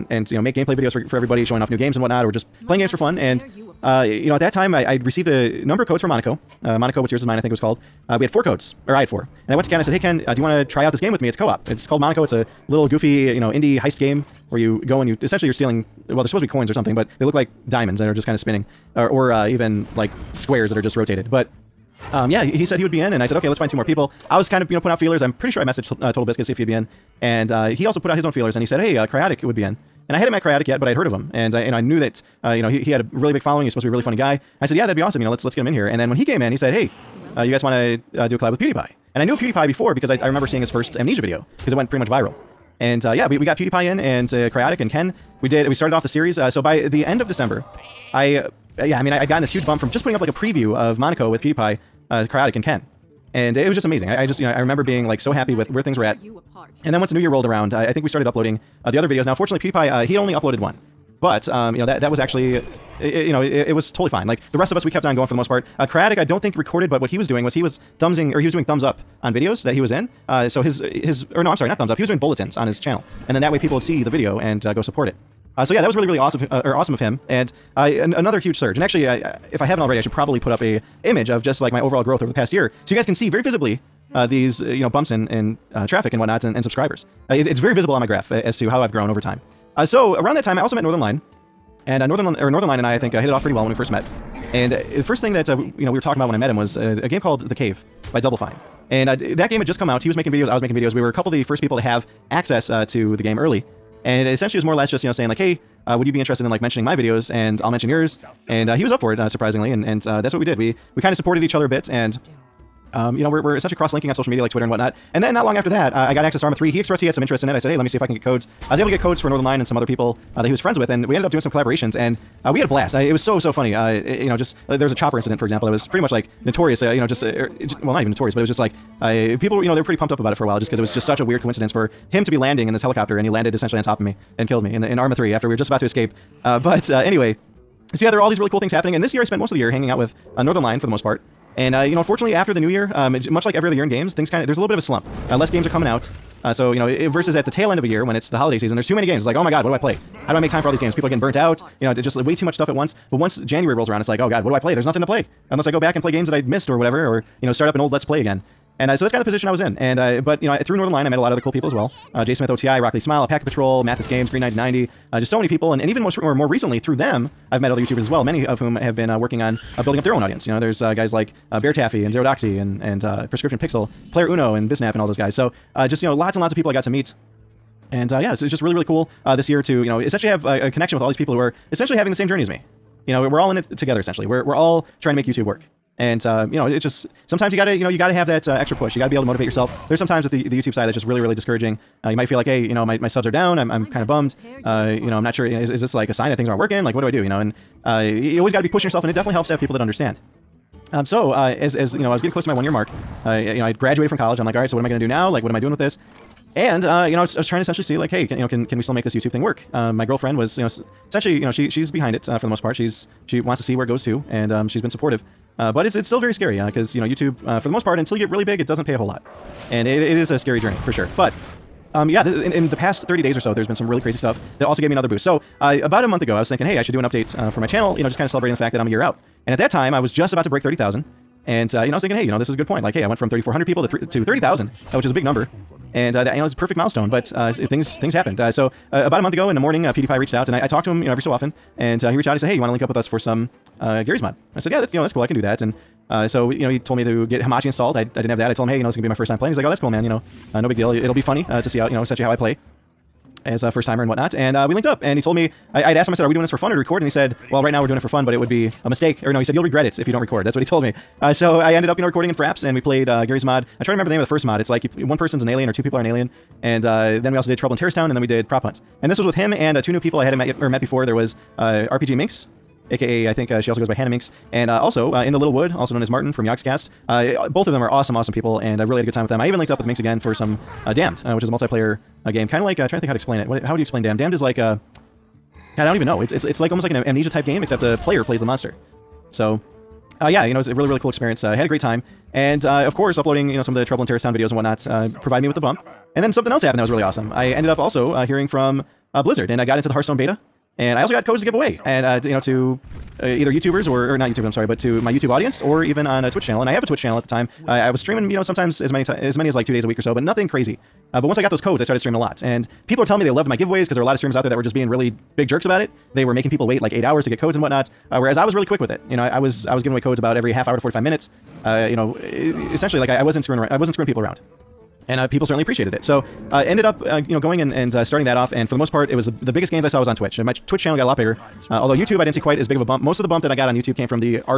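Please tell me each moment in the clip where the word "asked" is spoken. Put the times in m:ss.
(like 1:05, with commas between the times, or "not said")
4:15.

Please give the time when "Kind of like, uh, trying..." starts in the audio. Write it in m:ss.
4:42.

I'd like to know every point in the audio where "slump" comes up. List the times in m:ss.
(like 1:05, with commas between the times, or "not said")
2:24.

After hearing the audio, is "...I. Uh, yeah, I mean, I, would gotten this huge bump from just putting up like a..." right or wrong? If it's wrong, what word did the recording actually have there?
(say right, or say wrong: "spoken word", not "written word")
right.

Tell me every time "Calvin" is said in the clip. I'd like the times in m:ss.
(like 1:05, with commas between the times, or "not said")
not said.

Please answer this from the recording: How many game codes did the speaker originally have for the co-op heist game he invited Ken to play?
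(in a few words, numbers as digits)
4.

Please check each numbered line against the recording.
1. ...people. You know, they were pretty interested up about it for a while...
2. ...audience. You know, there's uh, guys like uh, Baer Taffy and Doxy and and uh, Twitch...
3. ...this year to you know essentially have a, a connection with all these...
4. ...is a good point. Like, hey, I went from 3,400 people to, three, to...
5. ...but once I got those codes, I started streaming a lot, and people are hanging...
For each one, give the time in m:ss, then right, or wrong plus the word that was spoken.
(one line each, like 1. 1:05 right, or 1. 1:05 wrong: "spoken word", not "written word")
1. 2:09 wrong: "pumped", not "interested"
2. 2:50 wrong: "Prescription", not "Twitch"
3. 2:59 right
4. 3:52 right
5. 5:11 wrong: "telling", not "hanging".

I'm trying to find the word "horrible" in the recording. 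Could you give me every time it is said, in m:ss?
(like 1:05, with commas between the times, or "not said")
not said.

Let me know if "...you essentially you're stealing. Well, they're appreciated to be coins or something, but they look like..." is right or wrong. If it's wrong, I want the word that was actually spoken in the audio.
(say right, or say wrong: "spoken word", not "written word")
wrong: "supposed", not "appreciated".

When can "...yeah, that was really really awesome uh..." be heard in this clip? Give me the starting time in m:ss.
1:15.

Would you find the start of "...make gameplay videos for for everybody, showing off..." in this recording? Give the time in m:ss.
0:00.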